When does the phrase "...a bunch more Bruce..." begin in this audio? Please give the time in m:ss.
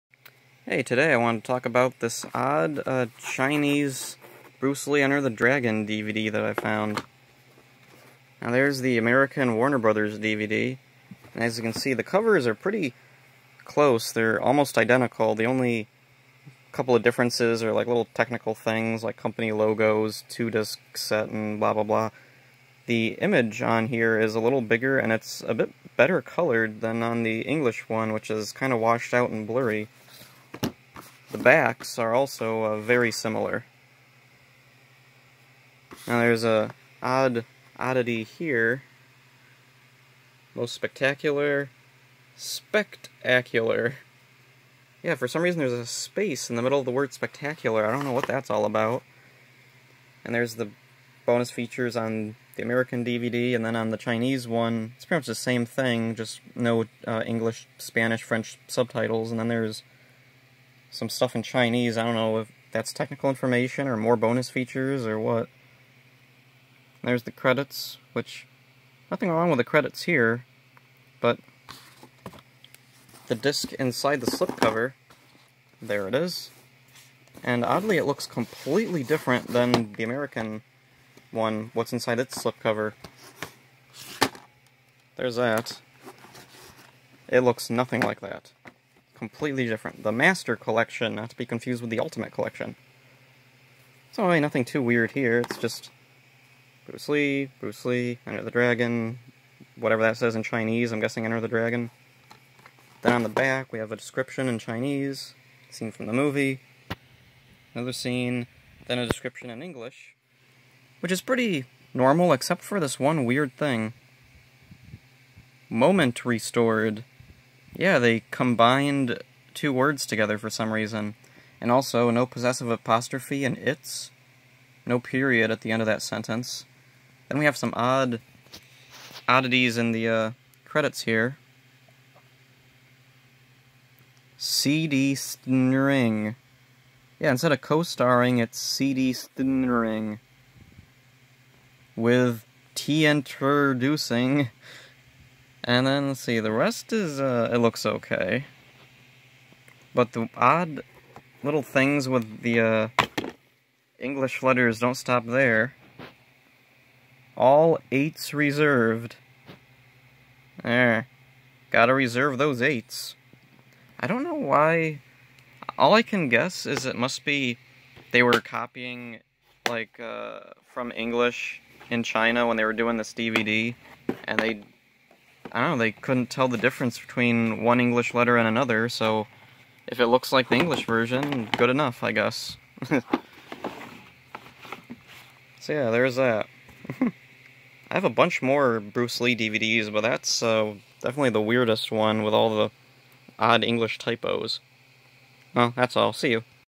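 3:08.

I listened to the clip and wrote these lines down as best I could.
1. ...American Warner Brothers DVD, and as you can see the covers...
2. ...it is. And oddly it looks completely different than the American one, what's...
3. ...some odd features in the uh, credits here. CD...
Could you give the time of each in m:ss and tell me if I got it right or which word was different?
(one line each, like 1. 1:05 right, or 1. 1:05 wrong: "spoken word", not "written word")
1. 0:08 right
2. 1:16 right
3. 2:07 wrong: "oddities", not "features".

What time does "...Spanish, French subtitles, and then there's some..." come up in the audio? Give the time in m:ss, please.
0:57.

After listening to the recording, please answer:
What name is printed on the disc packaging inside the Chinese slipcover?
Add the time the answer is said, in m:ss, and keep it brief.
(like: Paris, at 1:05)
The Master Collection, at 1:30.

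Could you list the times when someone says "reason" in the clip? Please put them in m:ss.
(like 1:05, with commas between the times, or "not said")
0:45, 2:00.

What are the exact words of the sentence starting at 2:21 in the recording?
With T introducing and then let's see, the rest is, uh, it looks okay.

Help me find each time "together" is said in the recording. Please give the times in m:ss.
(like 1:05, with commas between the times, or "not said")
2:00.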